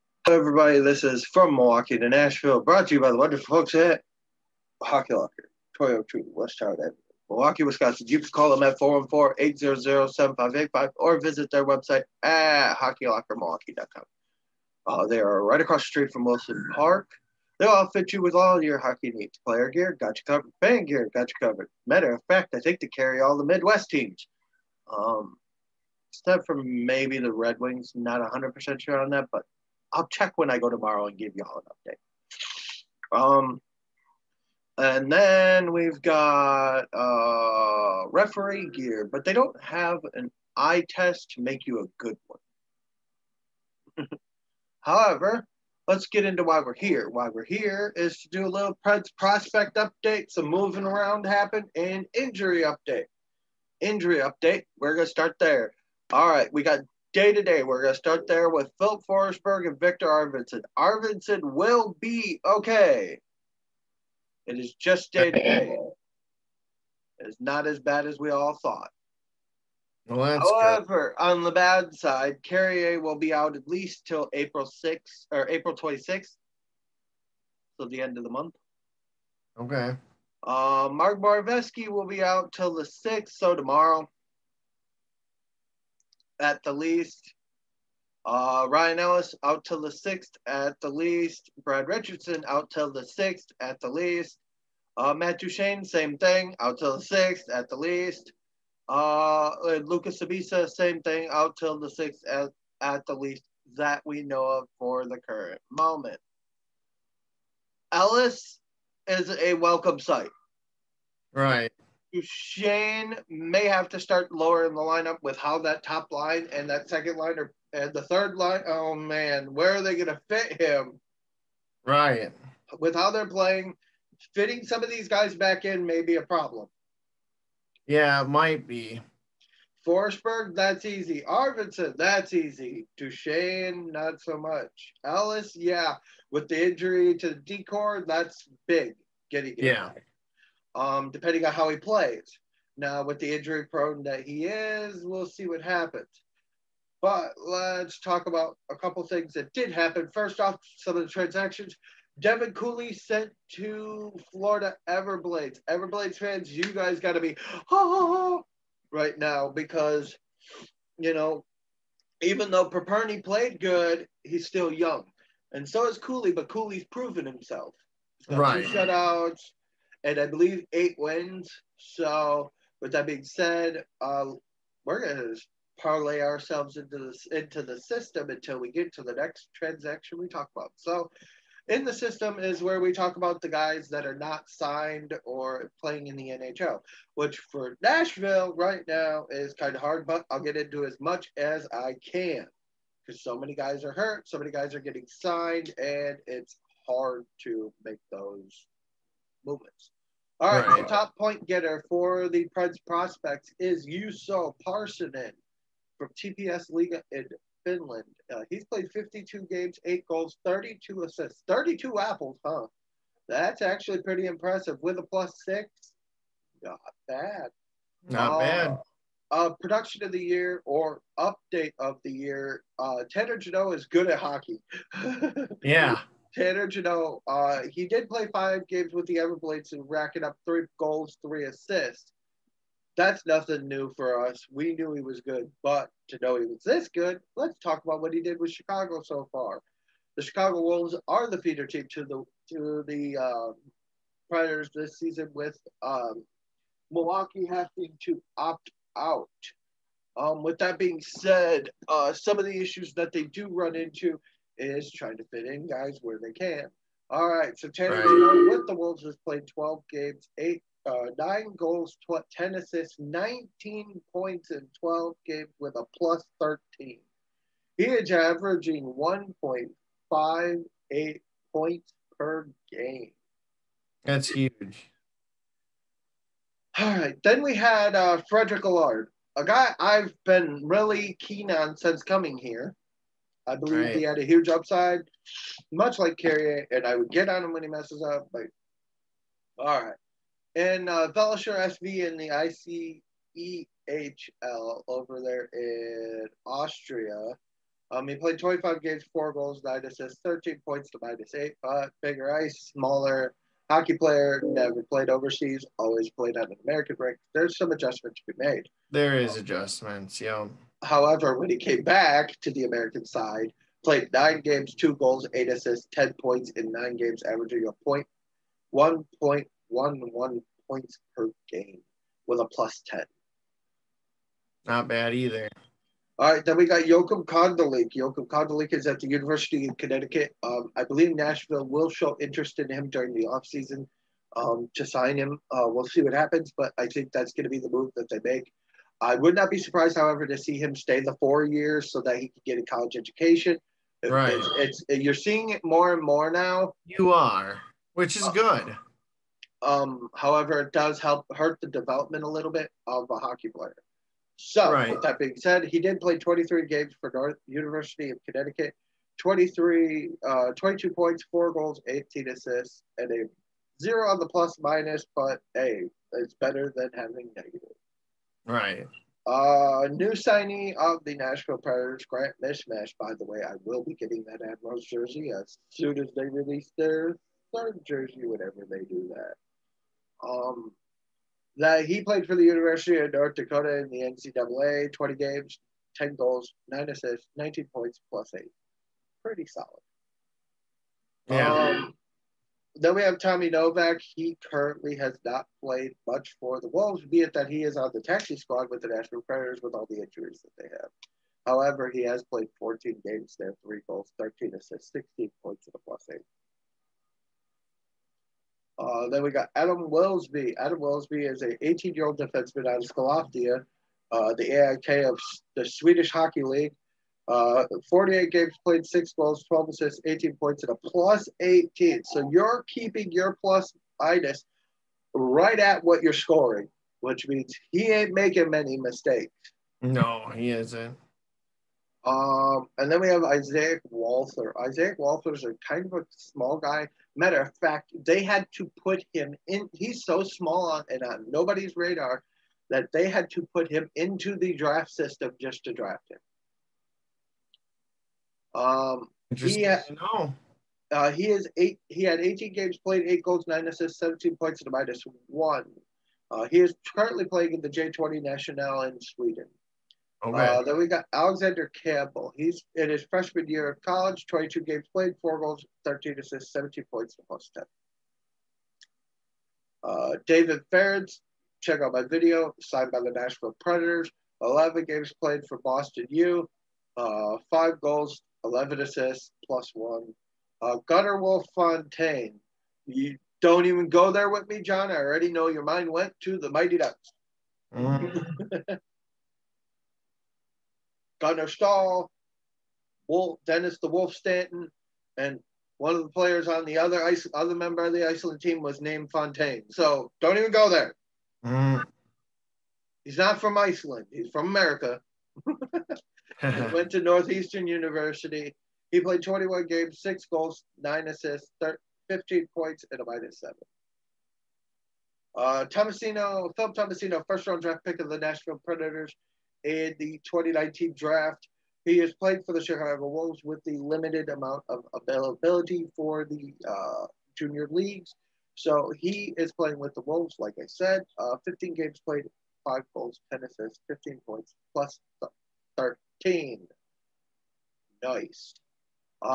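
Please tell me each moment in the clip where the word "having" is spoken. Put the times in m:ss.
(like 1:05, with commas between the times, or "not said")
4:07, 6:06.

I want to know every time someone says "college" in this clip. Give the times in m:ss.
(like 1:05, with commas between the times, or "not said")
5:42, 7:43.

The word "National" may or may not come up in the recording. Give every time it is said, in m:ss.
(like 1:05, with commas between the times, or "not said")
6:38, 7:38.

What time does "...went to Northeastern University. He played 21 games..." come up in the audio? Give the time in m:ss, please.
8:26.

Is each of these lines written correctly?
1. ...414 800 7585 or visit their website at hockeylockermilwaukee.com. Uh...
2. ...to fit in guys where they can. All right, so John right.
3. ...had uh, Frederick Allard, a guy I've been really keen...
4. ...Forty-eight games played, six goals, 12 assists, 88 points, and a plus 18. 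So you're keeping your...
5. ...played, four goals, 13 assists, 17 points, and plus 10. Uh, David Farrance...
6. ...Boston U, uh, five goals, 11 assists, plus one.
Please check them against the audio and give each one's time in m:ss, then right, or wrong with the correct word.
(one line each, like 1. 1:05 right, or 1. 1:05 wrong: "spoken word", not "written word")
1. 0:08 right
2. 4:15 wrong: "Tanner", not "John"
3. 4:37 right
4. 6:57 wrong: "18", not "88"
5. 7:44 right
6. 7:55 right.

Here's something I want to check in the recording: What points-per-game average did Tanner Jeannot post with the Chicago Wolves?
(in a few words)
1.58.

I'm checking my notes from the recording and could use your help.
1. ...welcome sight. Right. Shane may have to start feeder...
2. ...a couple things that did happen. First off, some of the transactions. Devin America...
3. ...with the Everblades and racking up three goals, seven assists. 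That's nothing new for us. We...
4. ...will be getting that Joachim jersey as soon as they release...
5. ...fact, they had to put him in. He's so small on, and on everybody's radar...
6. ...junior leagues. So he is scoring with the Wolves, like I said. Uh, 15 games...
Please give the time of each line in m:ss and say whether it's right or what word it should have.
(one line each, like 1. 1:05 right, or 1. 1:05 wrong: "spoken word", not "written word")
1. 1:49 wrong: "lower", not "feeder"
2. 2:28 wrong: "Cooley", not "America"
3. 3:48 wrong: "three", not "seven"
4. 6:13 wrong: "Admirals", not "Joachim"
5. 7:17 wrong: "nobody", not "everybody"
6. 8:47 wrong: "playing", not "scoring".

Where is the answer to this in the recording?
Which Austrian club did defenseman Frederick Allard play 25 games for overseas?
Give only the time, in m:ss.
4:51.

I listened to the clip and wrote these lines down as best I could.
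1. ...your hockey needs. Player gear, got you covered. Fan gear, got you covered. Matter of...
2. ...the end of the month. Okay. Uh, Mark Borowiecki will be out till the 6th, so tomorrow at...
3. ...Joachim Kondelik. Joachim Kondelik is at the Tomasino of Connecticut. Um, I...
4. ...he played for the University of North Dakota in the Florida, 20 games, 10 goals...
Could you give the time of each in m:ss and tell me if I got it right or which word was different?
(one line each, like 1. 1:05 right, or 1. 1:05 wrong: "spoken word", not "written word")
1. 0:18 right
2. 1:17 right
3. 5:26 wrong: "University", not "Tomasino"
4. 6:21 wrong: "NCAA", not "Florida".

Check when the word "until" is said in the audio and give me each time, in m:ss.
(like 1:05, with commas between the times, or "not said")
2:58.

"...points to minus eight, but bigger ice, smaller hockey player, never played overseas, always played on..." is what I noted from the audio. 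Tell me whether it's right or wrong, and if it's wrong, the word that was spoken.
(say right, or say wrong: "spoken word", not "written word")
right.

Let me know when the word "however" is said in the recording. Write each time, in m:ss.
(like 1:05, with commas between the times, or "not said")
0:44, 1:10, 5:10, 5:39, 5:50, 6:41.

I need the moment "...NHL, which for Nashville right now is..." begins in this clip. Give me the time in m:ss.
3:06.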